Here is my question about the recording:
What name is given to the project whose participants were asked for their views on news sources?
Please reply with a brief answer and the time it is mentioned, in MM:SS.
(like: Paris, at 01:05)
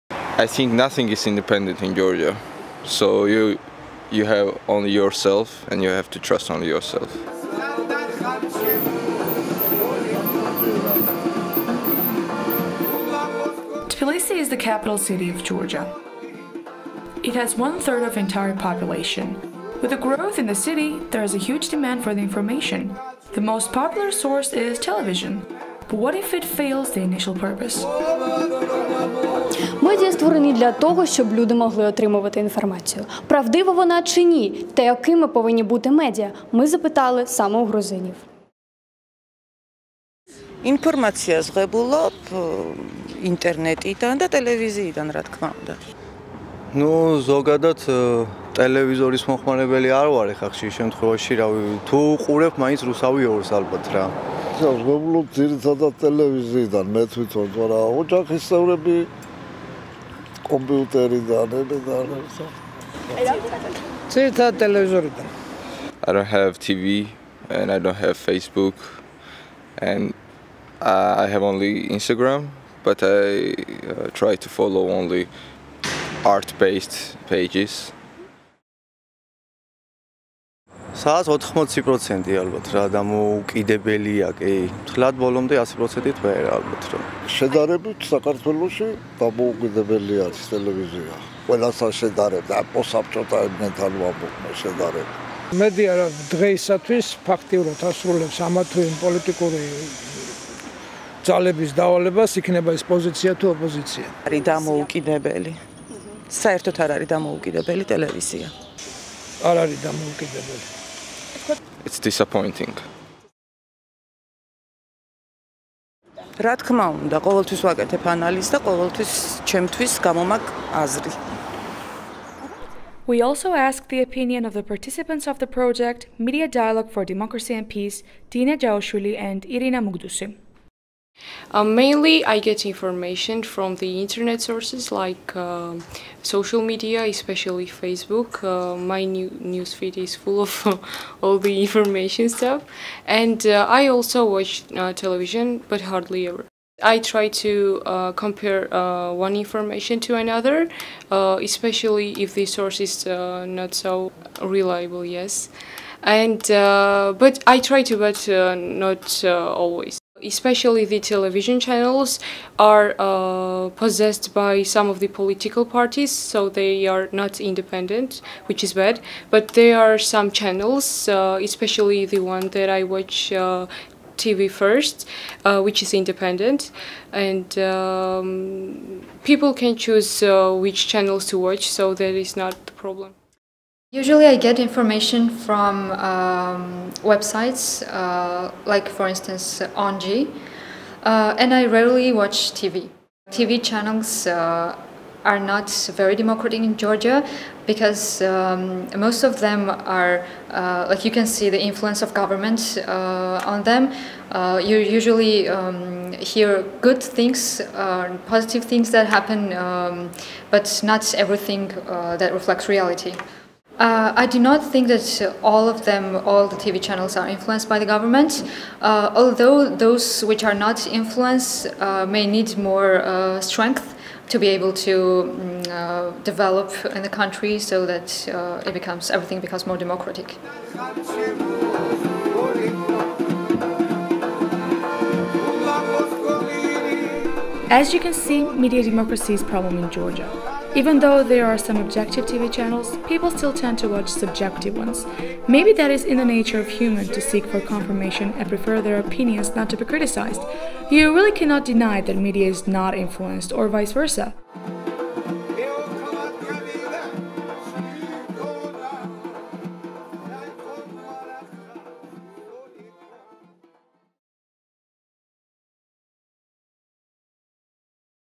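Media Dialogue for Democracy and Peace, at 02:06.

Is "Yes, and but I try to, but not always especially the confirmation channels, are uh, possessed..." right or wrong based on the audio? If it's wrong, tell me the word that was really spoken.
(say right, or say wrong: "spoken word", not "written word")
wrong: "television", not "confirmation".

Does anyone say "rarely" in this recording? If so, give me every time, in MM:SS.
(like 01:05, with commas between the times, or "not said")
03:11.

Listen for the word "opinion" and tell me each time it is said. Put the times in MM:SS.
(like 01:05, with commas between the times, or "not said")
02:04, 04:08.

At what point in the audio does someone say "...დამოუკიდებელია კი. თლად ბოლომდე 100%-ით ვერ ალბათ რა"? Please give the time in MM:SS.
01:22.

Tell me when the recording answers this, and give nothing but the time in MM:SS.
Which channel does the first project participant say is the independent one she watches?
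02:54.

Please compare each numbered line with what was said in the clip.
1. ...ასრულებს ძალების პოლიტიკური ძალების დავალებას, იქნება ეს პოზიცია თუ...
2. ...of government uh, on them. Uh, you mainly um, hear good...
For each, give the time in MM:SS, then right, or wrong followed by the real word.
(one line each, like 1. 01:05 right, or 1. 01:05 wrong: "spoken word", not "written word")
1. 01:37 wrong: "ამათვის", not "ძალების"
2. 03:22 wrong: "usually", not "mainly".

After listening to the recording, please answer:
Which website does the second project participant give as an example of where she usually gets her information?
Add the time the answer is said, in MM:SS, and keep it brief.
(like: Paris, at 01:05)
ONG, at 03:09.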